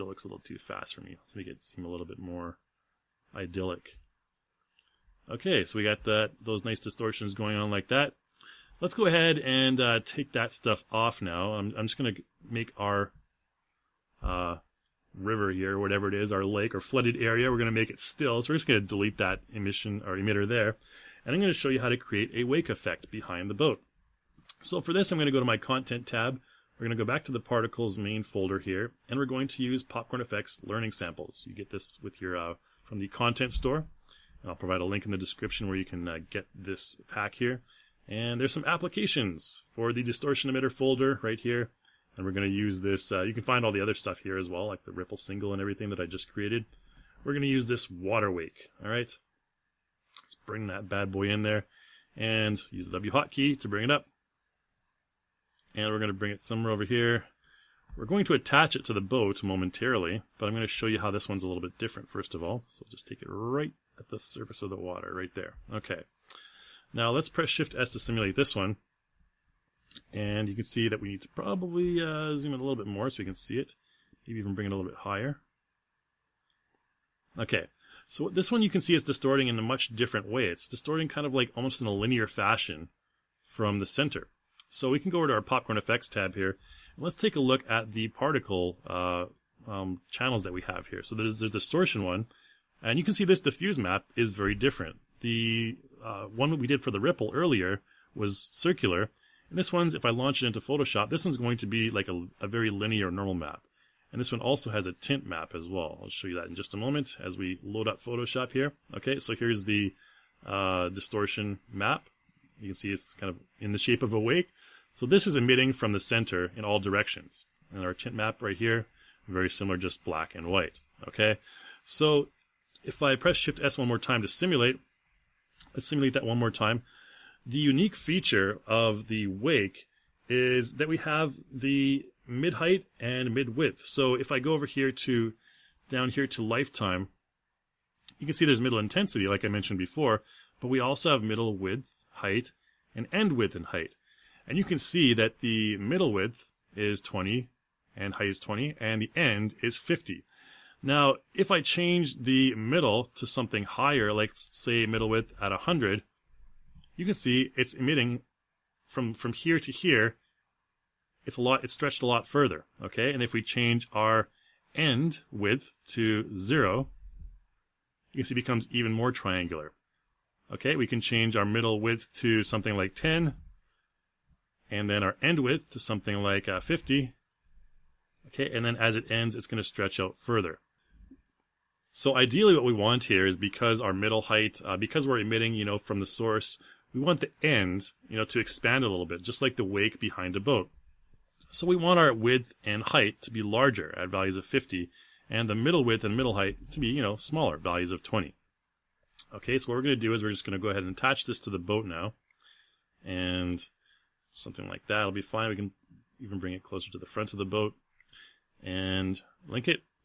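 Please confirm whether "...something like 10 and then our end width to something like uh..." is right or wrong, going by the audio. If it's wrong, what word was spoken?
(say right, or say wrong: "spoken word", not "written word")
right.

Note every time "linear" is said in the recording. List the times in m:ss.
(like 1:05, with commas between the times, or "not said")
1:21, 1:42.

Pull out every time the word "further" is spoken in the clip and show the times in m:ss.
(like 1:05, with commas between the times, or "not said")
2:42, 3:00.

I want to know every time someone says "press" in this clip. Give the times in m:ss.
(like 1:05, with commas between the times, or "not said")
1:07, 2:03.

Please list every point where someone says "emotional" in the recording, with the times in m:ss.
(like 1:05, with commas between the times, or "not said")
not said.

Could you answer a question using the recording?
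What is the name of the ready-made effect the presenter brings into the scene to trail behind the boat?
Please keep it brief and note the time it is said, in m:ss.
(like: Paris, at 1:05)
Water wake, at 0:47.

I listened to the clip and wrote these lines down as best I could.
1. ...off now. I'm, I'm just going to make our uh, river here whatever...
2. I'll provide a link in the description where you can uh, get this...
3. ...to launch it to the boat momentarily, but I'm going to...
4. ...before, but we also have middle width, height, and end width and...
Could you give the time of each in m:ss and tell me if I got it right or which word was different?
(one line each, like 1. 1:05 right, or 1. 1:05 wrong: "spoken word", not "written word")
1. 0:10 right
2. 0:34 right
3. 0:58 wrong: "attach", not "launch"
4. 2:19 right.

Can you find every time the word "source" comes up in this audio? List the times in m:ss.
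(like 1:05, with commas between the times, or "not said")
3:06.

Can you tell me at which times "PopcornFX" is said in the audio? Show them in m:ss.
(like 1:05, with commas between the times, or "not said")
0:29, 1:25.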